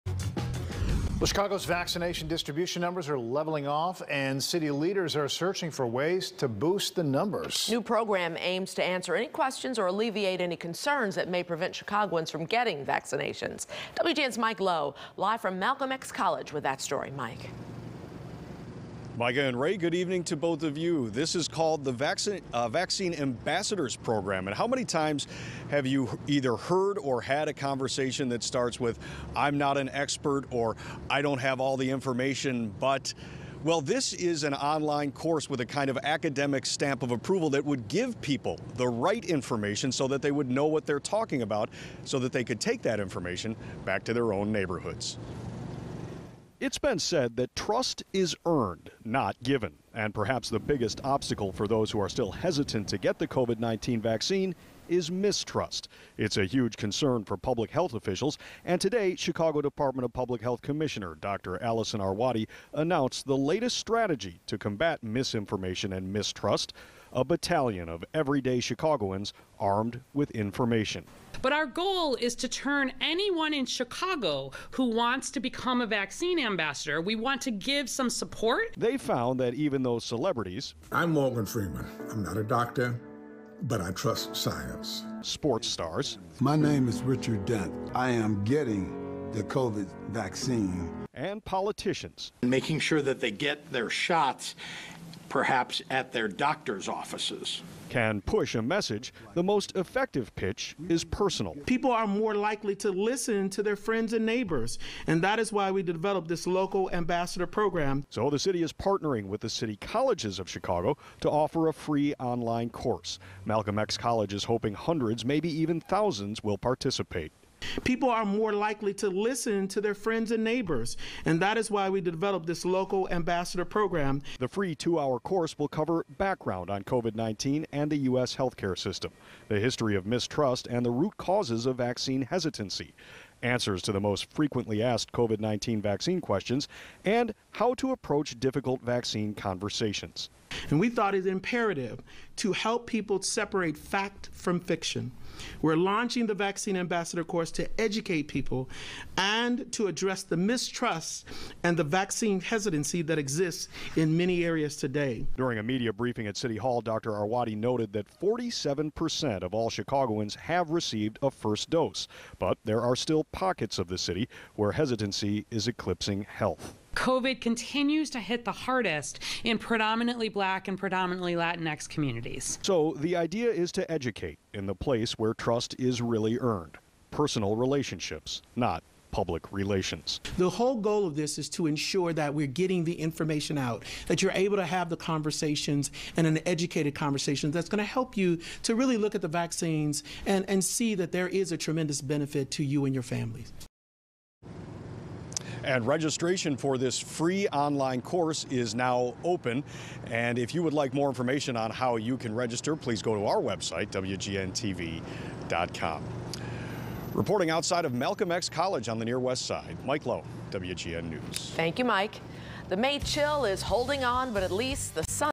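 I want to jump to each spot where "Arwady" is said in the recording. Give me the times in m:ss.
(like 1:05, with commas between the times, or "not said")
1:01, 2:37.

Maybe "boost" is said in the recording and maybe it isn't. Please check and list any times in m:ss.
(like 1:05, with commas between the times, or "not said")
0:06.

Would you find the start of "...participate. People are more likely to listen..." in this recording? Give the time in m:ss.
1:56.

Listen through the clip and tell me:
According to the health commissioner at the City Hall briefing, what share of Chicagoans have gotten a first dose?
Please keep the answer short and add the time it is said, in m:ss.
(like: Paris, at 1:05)
47%, at 2:38.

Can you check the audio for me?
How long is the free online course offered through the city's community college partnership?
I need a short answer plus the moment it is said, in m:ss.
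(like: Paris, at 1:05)
2 hours, at 2:04.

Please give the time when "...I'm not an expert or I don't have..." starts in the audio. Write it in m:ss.
0:29.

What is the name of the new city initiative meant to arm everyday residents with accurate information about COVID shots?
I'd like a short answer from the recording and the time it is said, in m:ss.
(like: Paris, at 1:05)
Vaccine Ambassadors Program, at 0:22.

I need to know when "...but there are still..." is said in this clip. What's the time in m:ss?
2:42.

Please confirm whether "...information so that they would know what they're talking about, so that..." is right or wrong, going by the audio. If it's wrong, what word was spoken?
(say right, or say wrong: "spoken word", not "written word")
right.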